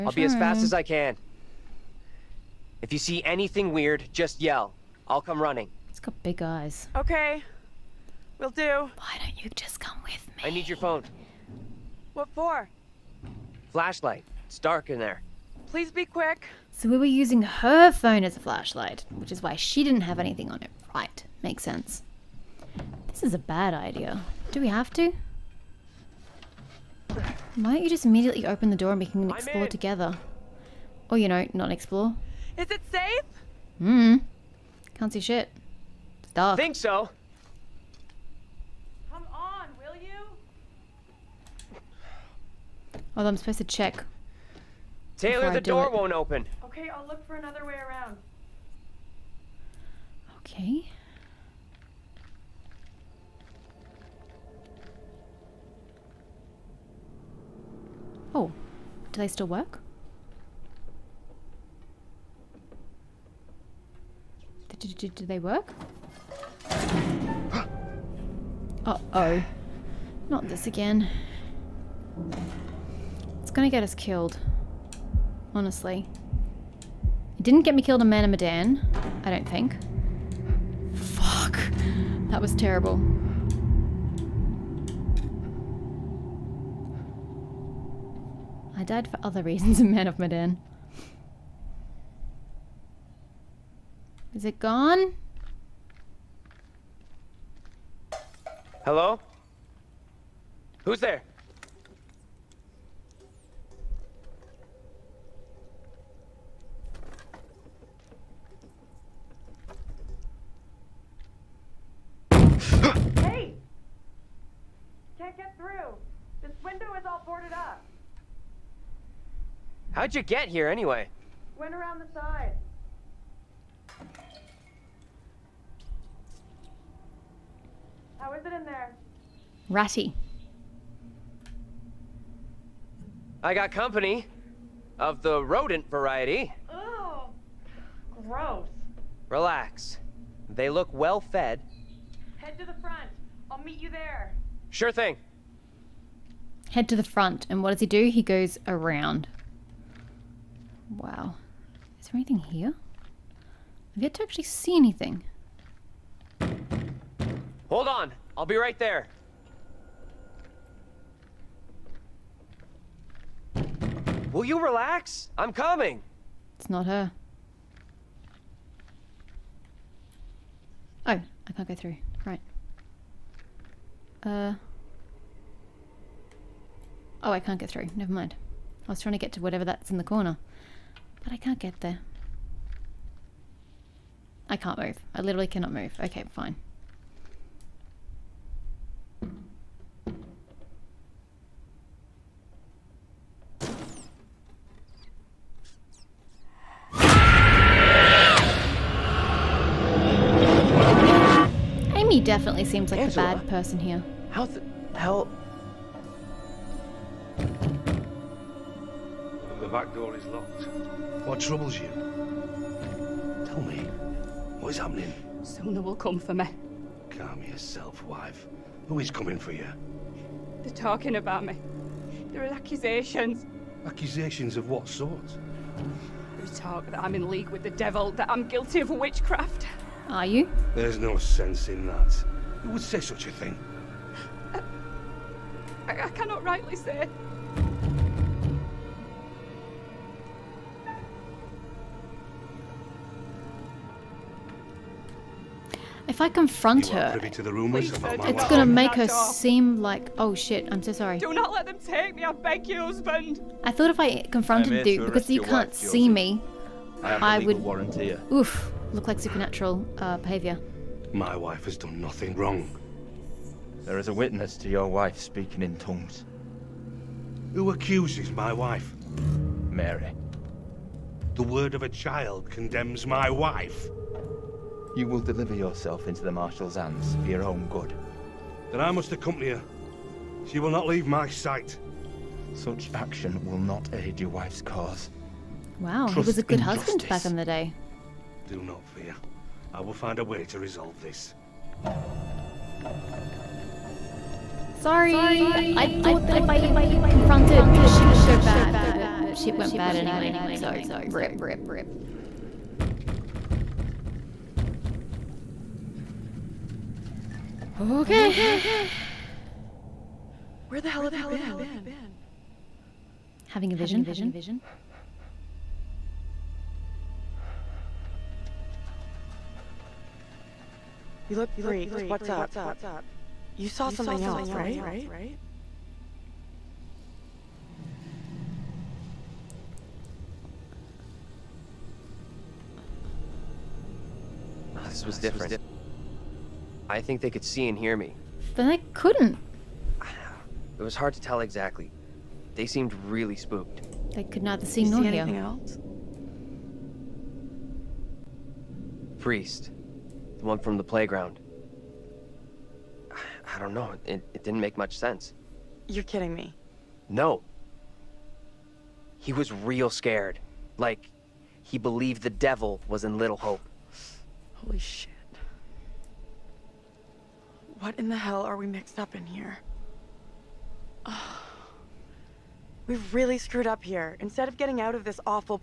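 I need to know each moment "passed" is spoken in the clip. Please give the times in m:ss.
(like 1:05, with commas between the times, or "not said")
not said.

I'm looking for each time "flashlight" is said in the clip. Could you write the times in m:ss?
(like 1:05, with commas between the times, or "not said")
0:13, 0:18.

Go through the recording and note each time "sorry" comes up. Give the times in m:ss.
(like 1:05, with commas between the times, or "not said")
4:10, 4:54.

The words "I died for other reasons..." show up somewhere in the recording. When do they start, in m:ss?
1:28.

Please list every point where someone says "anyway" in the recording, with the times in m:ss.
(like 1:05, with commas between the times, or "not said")
2:00, 4:59.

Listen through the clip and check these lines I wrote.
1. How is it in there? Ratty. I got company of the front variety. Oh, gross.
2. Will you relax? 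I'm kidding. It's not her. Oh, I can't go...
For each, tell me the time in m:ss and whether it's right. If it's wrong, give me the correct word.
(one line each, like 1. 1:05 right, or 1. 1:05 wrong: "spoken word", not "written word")
1. 2:08 wrong: "rodent", not "front"
2. 2:44 wrong: "coming", not "kidding".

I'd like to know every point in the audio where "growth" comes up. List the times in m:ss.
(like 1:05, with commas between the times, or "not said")
not said.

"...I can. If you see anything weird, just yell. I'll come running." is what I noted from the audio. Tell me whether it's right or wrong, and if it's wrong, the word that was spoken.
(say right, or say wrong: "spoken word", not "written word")
right.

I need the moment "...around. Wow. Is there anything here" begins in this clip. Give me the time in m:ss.
2:28.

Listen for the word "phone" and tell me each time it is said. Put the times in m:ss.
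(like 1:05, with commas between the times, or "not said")
0:10, 0:17.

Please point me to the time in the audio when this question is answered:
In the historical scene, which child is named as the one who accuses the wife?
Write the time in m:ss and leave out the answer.
4:29.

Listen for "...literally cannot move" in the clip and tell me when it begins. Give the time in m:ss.
3:05.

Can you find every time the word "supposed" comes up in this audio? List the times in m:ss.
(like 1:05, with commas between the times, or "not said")
0:43.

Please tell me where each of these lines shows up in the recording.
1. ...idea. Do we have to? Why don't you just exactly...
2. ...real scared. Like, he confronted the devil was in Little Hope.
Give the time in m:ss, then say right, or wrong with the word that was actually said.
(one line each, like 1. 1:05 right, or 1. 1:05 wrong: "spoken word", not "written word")
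1. 0:23 wrong: "immediately", not "exactly"
2. 5:59 wrong: "believed", not "confronted".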